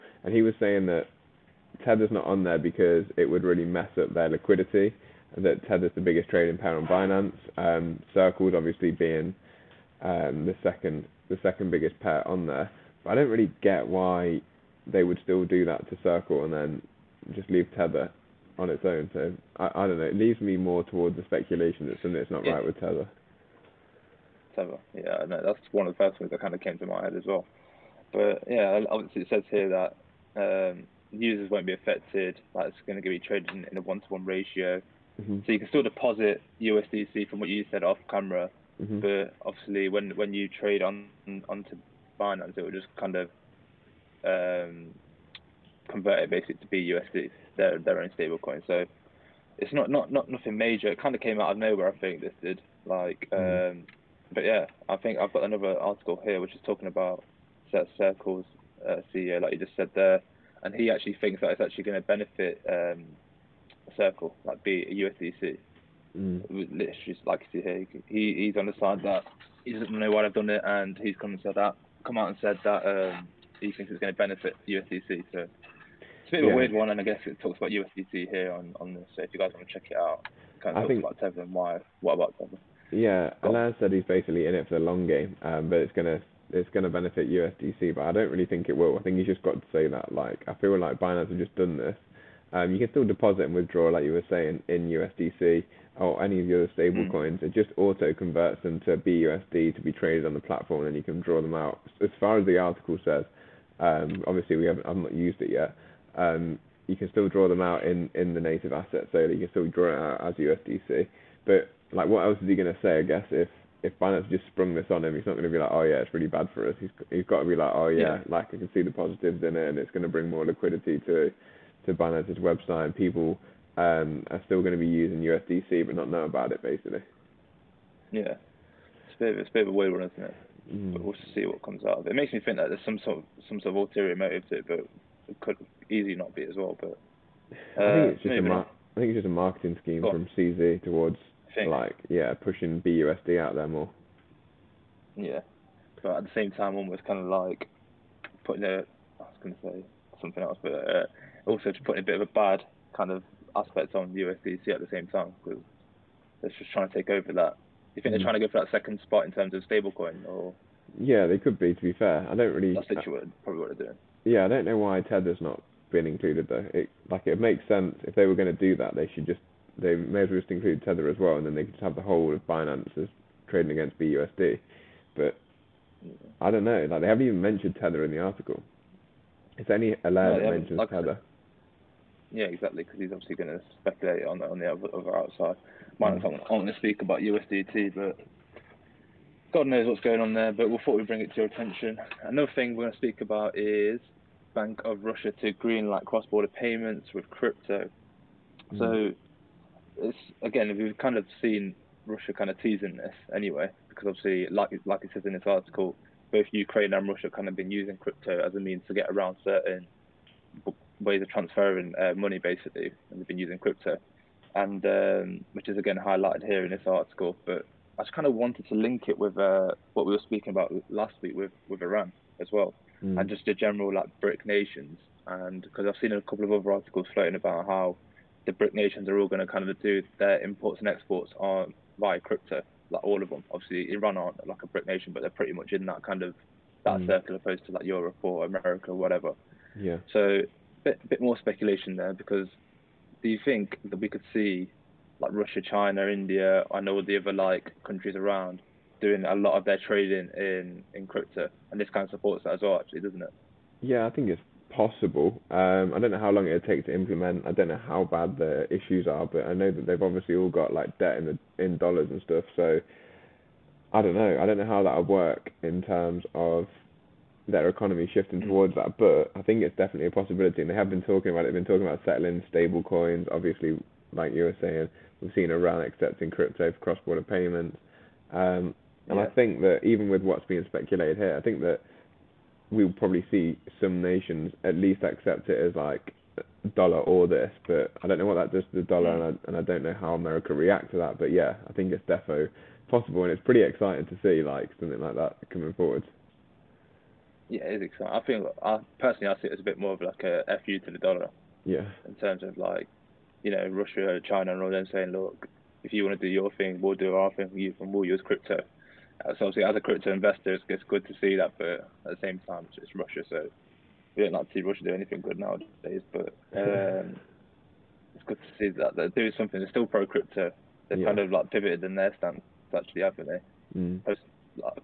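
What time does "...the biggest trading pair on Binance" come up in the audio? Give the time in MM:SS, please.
00:05.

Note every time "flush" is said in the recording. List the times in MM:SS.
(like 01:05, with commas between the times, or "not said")
not said.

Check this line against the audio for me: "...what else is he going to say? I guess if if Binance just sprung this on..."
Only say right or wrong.
right.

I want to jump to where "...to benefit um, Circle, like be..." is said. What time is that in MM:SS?
01:02.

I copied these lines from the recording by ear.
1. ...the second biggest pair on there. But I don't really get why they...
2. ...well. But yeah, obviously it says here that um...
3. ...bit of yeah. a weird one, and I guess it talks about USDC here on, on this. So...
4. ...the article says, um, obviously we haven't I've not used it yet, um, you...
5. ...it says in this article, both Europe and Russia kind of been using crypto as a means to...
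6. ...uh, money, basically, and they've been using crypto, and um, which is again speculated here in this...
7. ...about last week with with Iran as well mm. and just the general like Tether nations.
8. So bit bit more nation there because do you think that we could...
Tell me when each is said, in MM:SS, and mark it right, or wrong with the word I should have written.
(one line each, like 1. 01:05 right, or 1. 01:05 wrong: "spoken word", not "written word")
1. 00:11 right
2. 00:27 right
3. 01:16 right
4. 01:42 right
5. 03:25 wrong: "Ukraine", not "Europe"
6. 03:31 wrong: "highlighted", not "speculated"
7. 03:40 wrong: "BRIC", not "Tether"
8. 04:00 wrong: "speculation", not "nation".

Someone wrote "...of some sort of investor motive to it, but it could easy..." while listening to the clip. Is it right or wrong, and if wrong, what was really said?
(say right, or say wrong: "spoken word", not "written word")
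wrong: "ulterior", not "investor".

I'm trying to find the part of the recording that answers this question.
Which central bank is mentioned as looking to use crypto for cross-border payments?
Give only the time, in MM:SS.
03:14.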